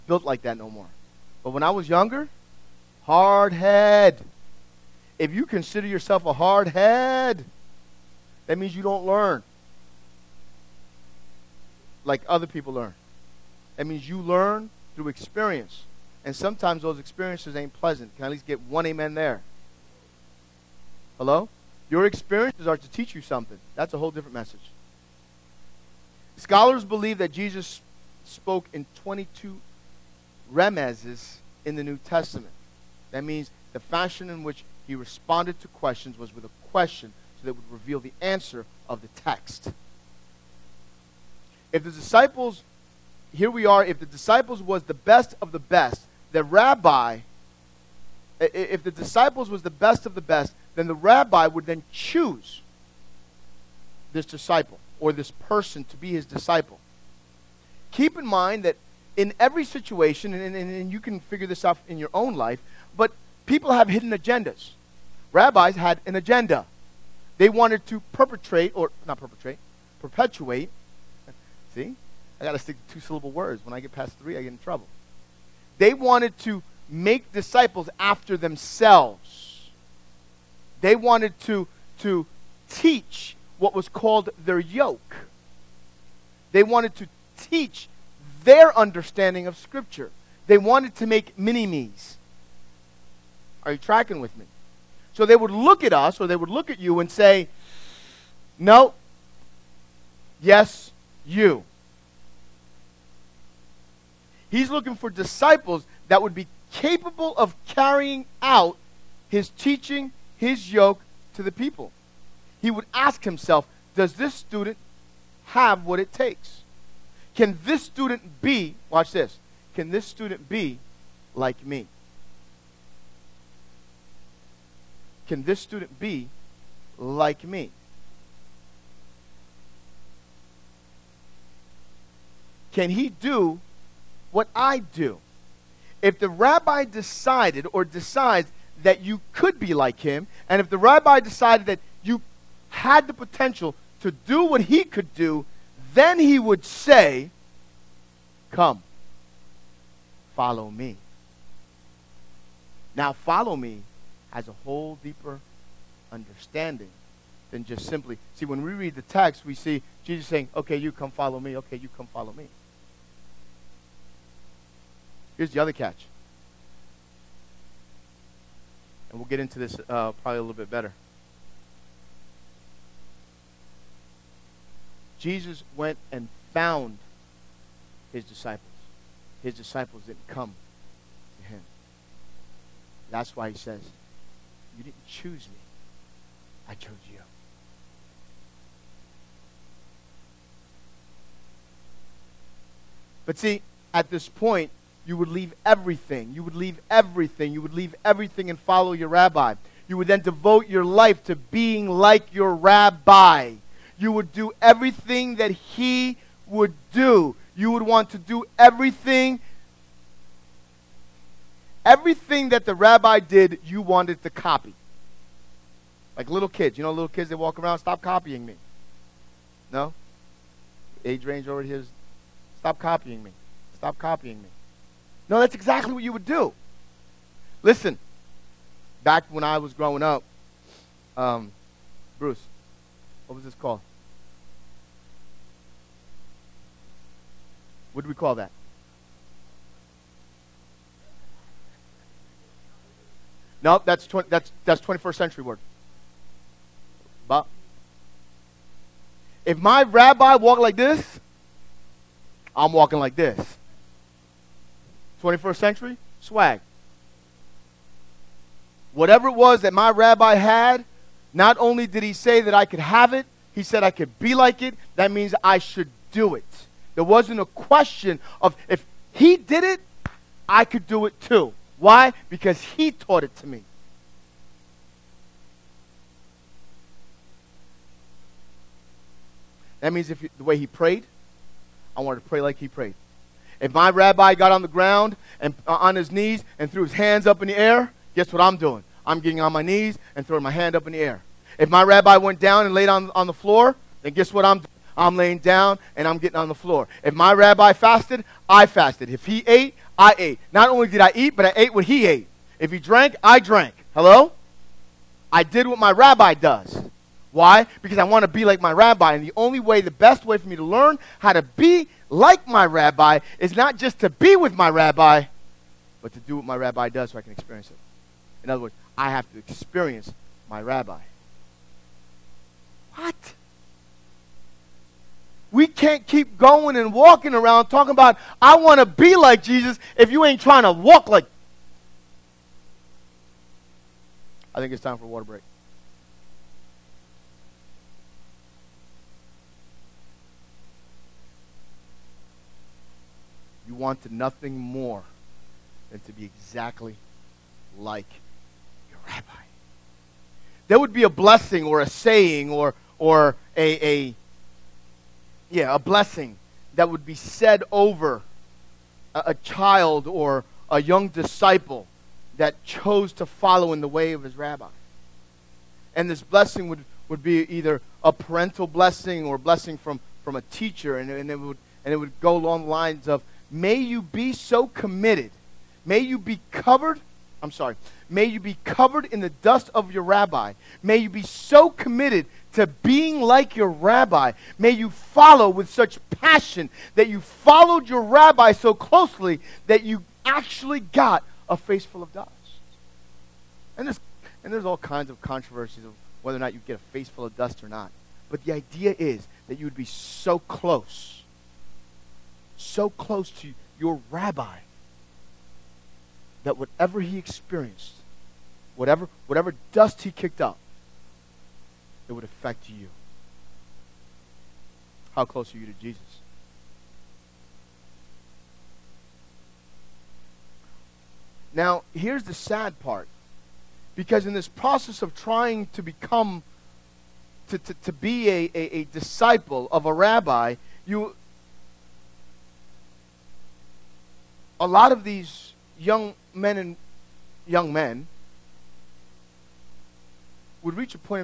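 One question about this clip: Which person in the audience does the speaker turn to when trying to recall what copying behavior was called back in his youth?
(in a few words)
Bruce.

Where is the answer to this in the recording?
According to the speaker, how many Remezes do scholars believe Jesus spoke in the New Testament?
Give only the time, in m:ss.
0:29.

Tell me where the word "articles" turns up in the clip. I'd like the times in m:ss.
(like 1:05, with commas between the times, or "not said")
not said.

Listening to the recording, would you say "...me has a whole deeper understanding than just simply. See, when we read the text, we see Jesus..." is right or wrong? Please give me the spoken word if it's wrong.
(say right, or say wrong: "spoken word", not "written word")
right.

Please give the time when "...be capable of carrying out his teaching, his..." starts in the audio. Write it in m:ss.
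1:46.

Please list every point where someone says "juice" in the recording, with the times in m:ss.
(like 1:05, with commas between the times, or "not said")
not said.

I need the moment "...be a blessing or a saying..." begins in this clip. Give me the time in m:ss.
5:50.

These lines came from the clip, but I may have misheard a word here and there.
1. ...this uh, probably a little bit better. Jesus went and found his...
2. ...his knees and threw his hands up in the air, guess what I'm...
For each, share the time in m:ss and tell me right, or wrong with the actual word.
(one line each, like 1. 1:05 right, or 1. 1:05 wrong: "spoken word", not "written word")
1. 2:49 right
2. 4:45 right.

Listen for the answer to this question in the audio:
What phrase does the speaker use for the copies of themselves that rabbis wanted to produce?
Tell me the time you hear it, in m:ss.
1:31.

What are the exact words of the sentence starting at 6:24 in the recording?
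May you follow with such passion that you followed your rabbi so closely that you actually got a face full of dust.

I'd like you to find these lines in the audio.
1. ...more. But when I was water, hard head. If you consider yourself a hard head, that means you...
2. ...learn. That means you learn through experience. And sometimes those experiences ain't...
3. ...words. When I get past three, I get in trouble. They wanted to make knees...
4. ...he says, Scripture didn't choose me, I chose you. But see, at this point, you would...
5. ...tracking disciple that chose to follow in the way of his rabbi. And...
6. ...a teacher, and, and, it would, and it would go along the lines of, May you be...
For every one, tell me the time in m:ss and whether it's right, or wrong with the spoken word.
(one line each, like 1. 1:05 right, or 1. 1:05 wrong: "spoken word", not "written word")
1. 0:00 wrong: "younger", not "water"
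2. 0:12 right
3. 1:13 wrong: "disciples", not "knees"
4. 3:03 wrong: "You", not "Scripture"
5. 6:00 wrong: "young", not "tracking"
6. 6:10 right.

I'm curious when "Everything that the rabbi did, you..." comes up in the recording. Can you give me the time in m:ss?
3:31.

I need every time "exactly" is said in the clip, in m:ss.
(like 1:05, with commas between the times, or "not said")
3:45, 5:46.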